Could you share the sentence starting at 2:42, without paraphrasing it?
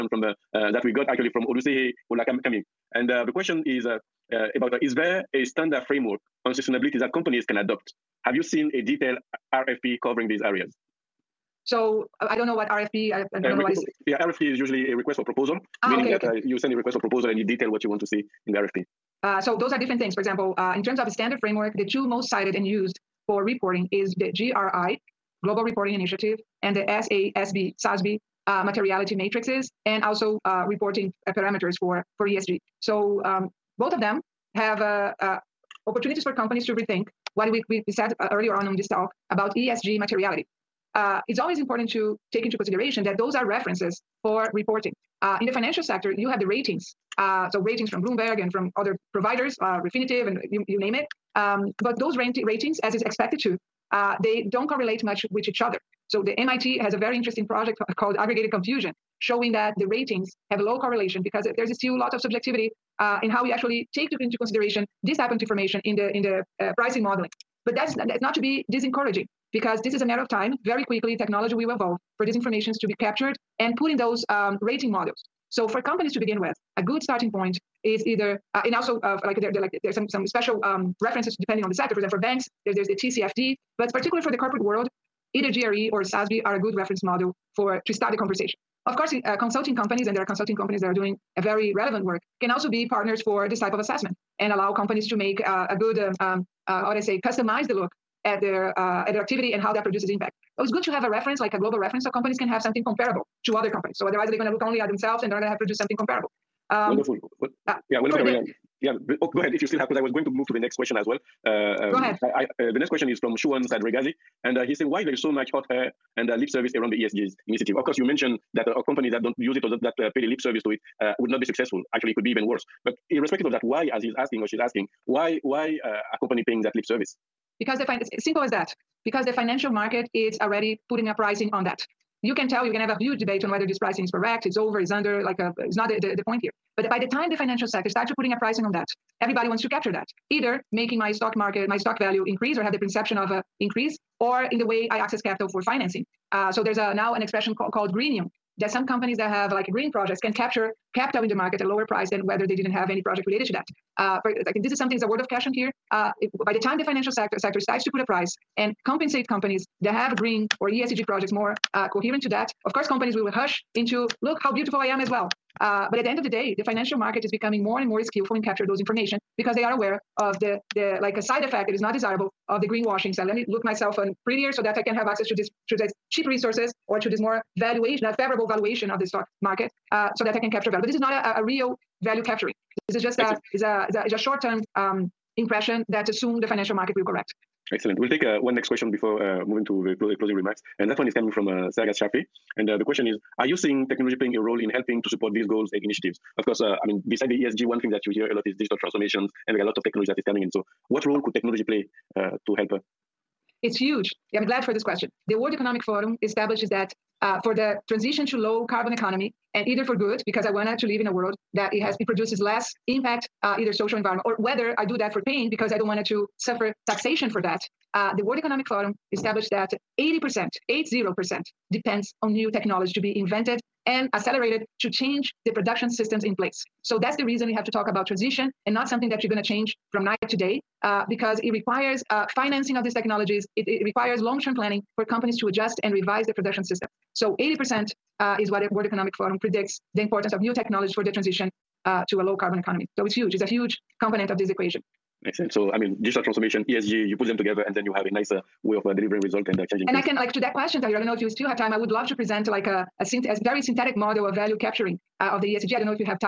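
Of course, companies will rush into look how beautiful I am as well.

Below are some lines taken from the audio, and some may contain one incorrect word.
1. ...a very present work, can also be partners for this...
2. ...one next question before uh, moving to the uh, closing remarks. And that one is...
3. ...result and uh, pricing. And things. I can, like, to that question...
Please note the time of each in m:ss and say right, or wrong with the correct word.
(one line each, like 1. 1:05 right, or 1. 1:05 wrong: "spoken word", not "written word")
1. 1:31 wrong: "relevant", not "present"
2. 3:08 right
3. 4:09 wrong: "changing", not "pricing".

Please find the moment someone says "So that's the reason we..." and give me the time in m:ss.
3:46.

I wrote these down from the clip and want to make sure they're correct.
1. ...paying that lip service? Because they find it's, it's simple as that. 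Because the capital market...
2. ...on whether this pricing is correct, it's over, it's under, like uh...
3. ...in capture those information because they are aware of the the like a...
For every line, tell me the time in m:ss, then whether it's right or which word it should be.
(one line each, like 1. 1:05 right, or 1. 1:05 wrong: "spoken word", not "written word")
1. 2:06 wrong: "financial", not "capital"
2. 2:13 right
3. 2:48 right.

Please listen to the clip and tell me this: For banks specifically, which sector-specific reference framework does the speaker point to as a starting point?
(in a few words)
TCFD.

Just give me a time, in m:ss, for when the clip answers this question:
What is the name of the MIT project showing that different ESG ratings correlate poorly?
0:58.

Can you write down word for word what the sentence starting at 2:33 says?
Uh, for, I think this is something is a word of caution here.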